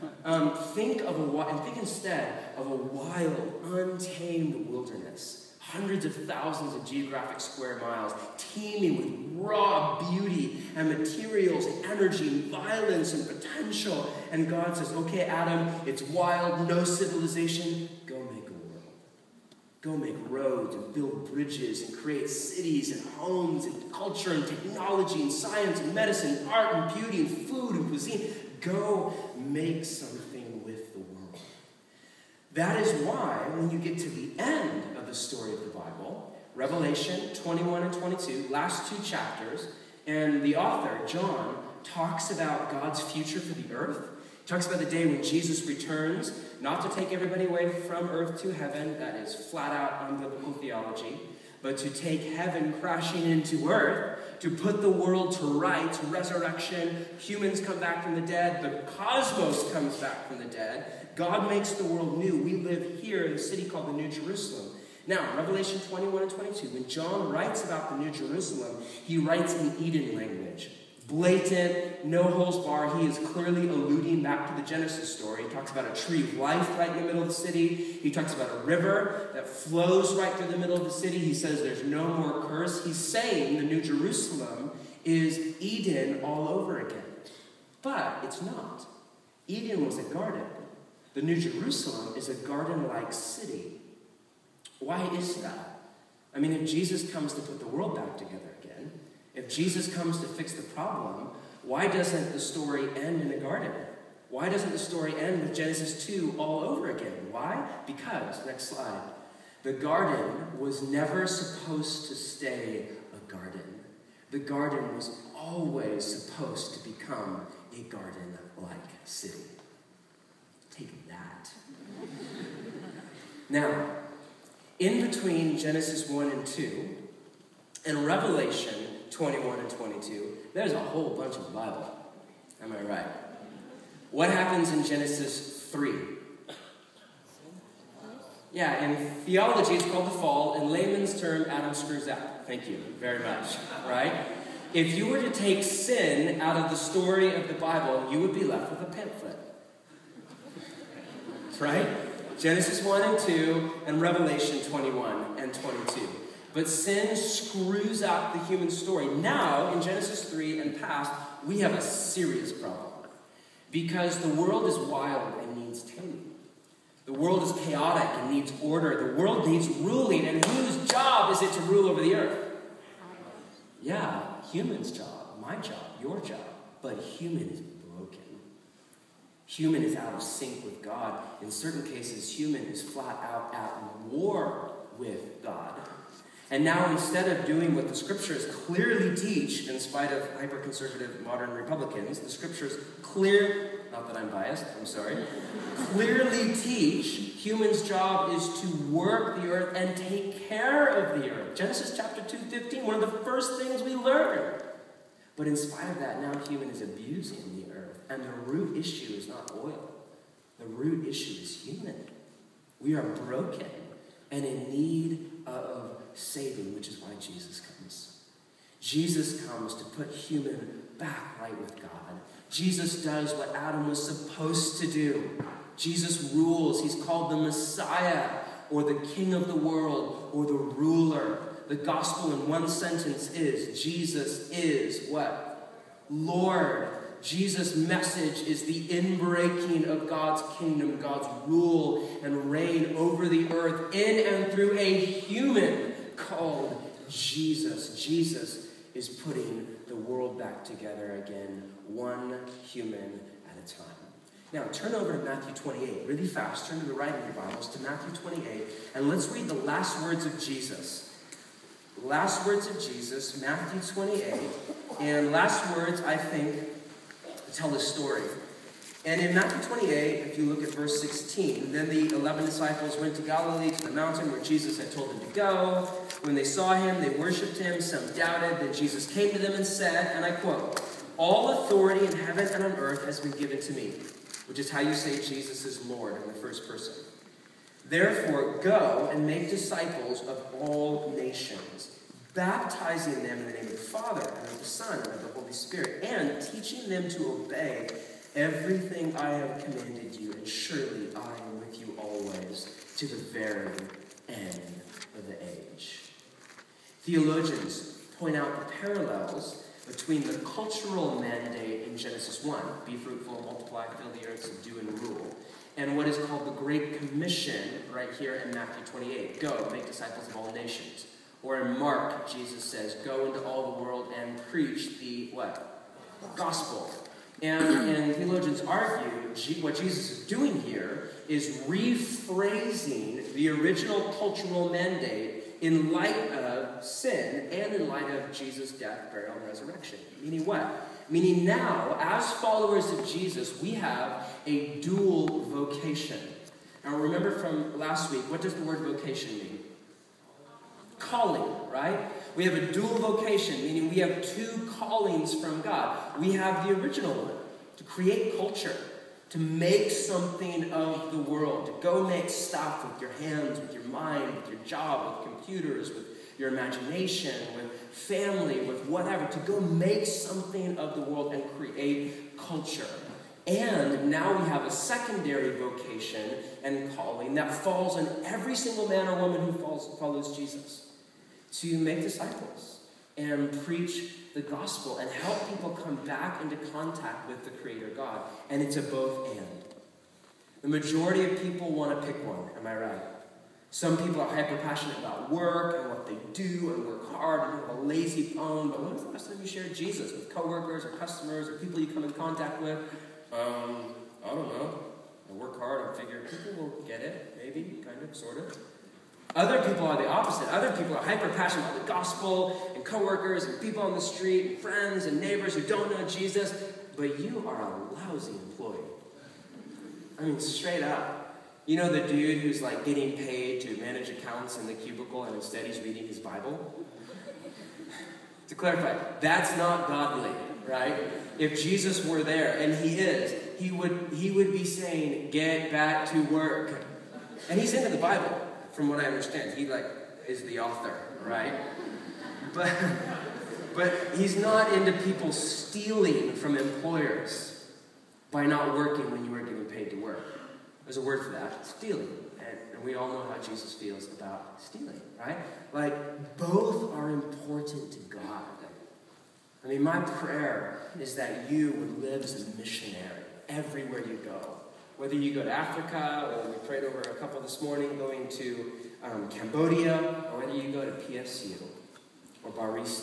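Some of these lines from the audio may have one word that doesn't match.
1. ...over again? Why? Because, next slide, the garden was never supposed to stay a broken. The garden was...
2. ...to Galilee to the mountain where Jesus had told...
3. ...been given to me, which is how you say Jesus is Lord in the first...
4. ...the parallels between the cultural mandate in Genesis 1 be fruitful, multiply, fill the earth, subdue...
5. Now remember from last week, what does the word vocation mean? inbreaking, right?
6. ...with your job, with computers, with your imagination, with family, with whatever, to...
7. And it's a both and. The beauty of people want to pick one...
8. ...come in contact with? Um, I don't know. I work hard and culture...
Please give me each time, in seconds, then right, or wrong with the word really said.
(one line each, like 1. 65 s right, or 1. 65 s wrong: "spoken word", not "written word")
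1. 106 s wrong: "garden", not "broken"
2. 273 s right
3. 283 s right
4. 308 s right
5. 346 s wrong: "calling", not "inbreaking"
6. 364 s right
7. 388 s wrong: "majority", not "beauty"
8. 401 s wrong: "figure", not "culture".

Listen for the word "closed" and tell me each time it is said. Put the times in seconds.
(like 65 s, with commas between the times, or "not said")
not said.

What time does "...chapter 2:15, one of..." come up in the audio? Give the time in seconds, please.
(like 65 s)
201 s.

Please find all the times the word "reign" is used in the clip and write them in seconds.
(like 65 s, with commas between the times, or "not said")
242 s.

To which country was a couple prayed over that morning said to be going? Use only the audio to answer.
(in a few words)
Cambodia.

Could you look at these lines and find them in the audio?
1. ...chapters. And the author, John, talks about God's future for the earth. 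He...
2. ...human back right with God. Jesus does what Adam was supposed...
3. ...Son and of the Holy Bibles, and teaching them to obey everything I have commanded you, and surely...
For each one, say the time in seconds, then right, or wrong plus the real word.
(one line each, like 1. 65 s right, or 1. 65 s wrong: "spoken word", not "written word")
1. 39 s right
2. 220 s right
3. 294 s wrong: "Spirit", not "Bibles".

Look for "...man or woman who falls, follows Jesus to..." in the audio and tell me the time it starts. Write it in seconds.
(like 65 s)
378 s.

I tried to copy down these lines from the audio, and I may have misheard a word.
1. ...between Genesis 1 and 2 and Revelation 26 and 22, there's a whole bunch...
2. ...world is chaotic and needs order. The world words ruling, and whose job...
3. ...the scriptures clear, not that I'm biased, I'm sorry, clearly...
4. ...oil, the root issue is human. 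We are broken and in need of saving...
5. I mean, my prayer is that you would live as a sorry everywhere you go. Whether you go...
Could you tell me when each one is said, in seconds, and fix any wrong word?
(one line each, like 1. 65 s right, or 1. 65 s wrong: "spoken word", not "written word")
1. 125 s wrong: "21", not "26"
2. 167 s wrong: "needs", not "words"
3. 192 s right
4. 209 s right
5. 459 s wrong: "missionary", not "sorry".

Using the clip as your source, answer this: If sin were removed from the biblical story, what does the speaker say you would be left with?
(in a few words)
a pamphlet.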